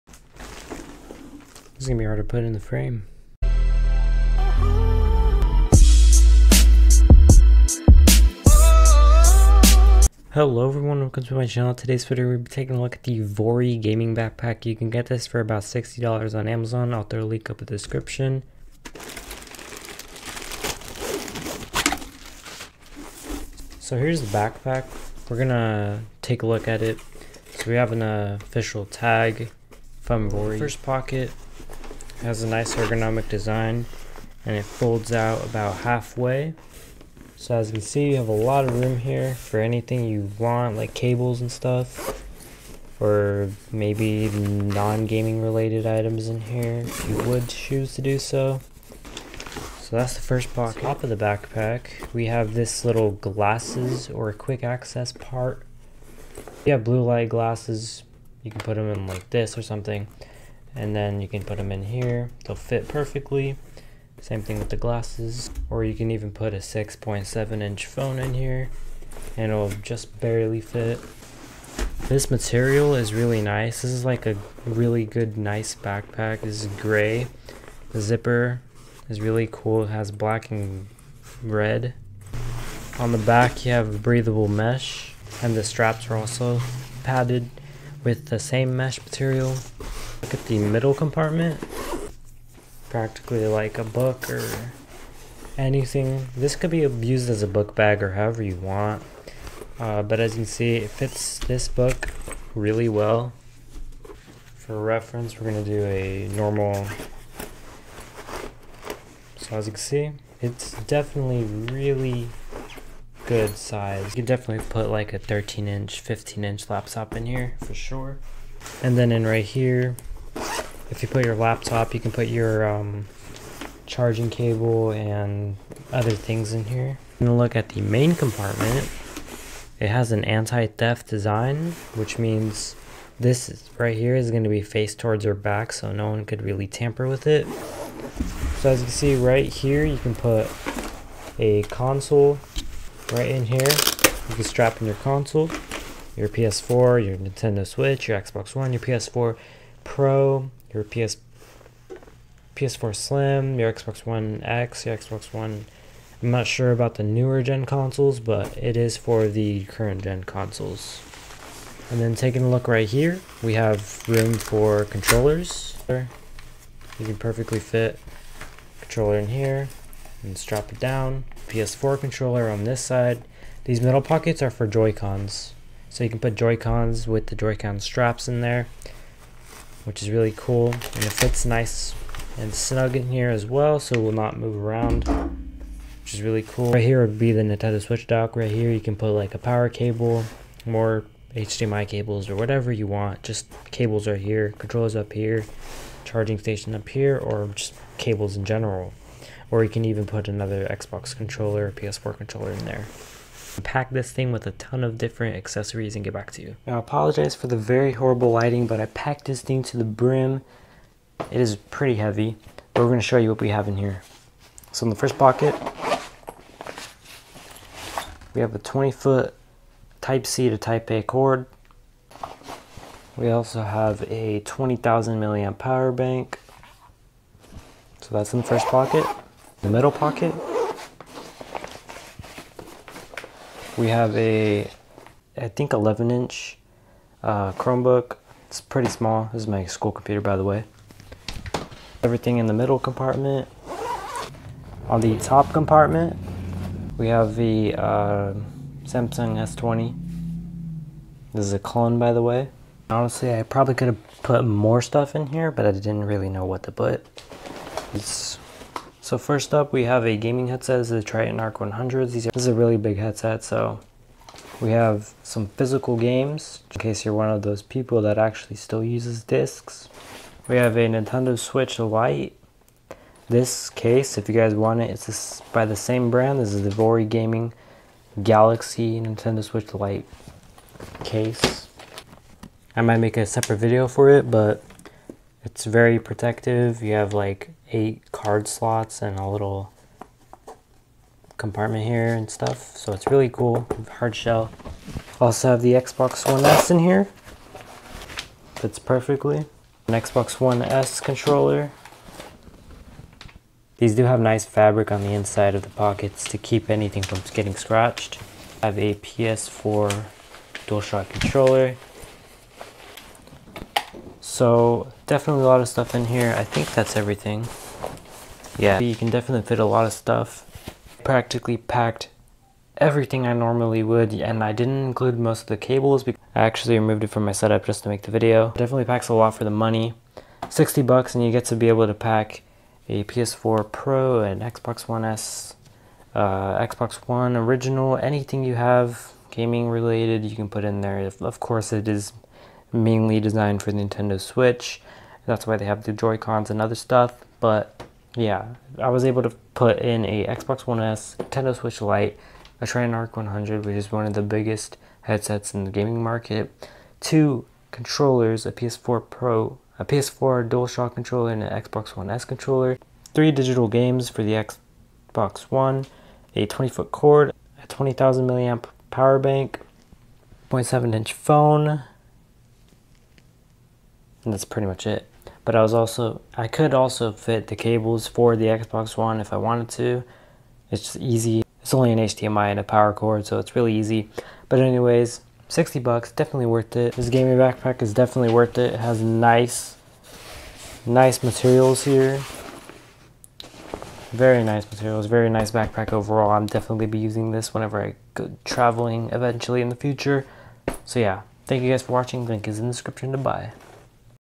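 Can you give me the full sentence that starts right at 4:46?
You have like eight card slots and a little compartment here and stuff.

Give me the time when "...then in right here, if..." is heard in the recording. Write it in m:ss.
1:58.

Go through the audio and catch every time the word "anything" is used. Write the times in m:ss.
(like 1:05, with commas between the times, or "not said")
0:39, 1:35, 5:06, 5:37.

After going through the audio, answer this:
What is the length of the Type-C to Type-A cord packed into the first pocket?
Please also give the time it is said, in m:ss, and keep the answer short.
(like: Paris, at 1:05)
20 foot, at 3:38.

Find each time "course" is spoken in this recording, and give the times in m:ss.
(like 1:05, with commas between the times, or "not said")
5:41.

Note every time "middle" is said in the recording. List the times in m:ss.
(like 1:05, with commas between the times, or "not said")
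1:30, 2:53, 3:49, 4:02.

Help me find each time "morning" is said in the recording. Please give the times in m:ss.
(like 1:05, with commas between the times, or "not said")
not said.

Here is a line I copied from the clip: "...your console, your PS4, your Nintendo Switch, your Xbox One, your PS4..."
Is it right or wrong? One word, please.
right.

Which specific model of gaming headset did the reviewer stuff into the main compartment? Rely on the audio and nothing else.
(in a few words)
Tritton ARK 100.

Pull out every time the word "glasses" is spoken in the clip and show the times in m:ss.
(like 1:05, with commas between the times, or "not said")
0:53, 0:57, 1:04.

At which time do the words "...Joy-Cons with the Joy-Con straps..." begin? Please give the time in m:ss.
2:56.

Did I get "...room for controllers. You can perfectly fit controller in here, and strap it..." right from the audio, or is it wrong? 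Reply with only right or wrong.
right.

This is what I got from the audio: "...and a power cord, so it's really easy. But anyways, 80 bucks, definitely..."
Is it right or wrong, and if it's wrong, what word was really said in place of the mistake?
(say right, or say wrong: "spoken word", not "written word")
wrong: "60", not "80".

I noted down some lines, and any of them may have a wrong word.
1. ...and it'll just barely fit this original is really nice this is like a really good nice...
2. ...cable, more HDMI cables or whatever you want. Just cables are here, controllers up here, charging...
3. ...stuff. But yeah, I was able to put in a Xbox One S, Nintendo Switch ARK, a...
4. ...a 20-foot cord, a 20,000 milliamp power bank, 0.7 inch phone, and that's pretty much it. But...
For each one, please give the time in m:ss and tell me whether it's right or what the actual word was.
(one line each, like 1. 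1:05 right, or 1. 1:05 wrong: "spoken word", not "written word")
1. 1:09 wrong: "material", not "original"
2. 3:09 right
3. 5:46 wrong: "Lite", not "ARK"
4. 6:06 right.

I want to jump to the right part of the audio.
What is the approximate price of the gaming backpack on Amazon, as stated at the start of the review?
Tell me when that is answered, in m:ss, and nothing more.
0:15.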